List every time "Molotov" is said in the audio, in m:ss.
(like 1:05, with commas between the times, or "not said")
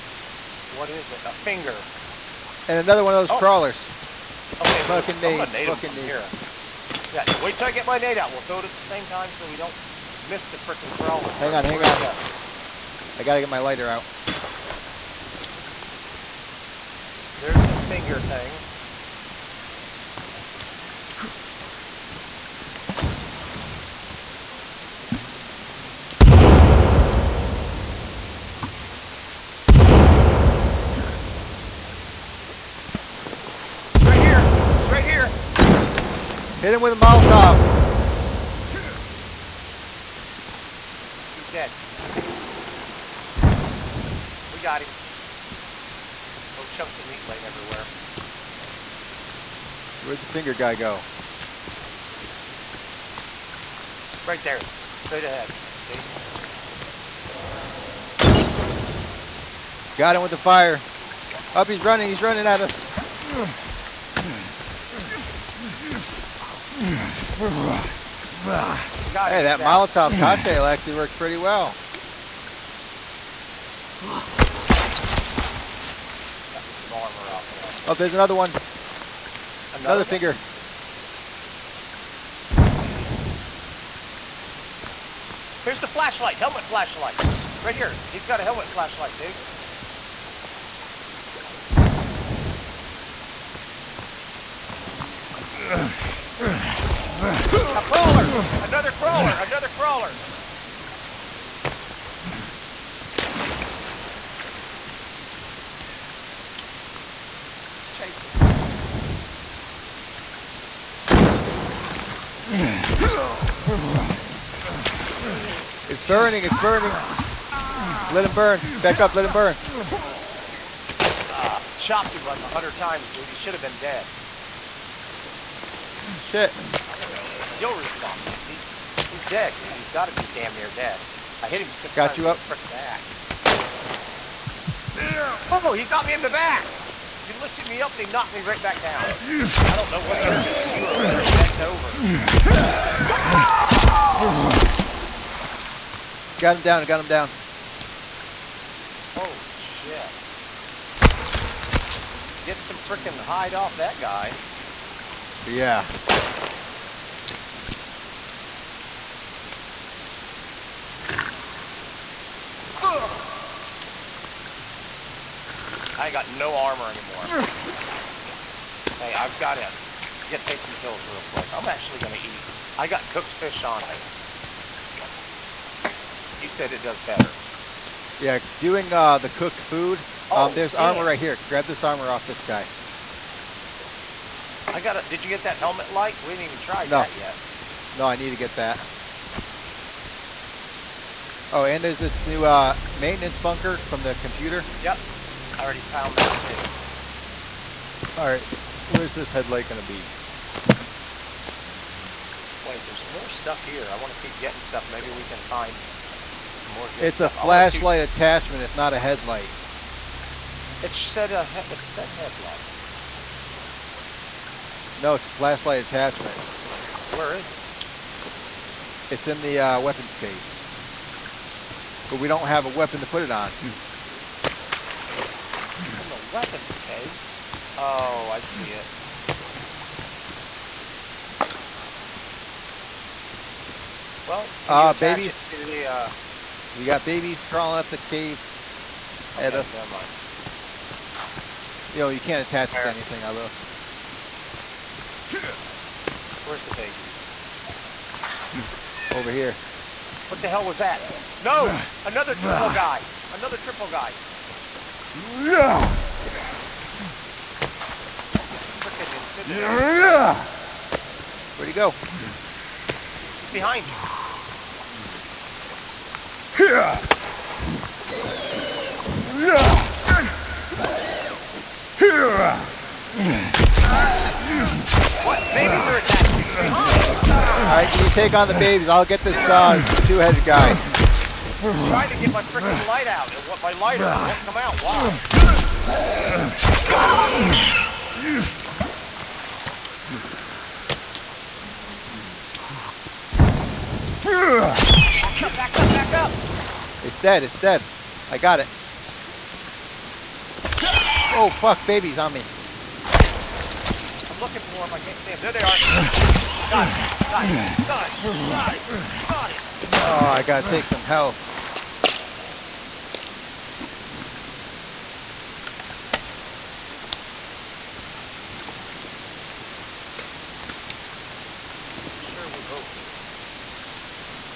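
0:36, 1:09.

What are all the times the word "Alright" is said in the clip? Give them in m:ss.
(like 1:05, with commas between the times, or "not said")
3:18, 4:37.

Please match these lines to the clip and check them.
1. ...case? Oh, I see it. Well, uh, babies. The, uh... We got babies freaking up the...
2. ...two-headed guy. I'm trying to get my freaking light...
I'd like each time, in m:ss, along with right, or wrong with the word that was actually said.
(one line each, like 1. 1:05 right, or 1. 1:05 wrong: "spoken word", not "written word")
1. 3:46 wrong: "crawling", not "freaking"
2. 4:40 right.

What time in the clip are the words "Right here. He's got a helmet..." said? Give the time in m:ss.
1:27.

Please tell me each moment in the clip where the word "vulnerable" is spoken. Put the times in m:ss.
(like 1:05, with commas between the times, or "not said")
not said.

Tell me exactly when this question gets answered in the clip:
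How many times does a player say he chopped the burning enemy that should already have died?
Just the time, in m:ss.
2:02.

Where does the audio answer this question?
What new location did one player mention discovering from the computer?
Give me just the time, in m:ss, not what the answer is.
3:12.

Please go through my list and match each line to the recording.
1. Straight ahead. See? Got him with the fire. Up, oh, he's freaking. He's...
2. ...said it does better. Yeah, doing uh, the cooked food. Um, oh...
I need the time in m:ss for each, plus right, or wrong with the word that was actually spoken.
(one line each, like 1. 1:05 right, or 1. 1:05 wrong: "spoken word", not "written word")
1. 0:54 wrong: "running", not "freaking"
2. 2:56 right.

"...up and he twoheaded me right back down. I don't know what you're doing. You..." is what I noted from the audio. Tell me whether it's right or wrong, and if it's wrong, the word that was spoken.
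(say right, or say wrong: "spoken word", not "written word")
wrong: "knocked", not "twoheaded".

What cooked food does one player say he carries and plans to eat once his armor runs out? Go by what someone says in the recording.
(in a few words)
cooked fish.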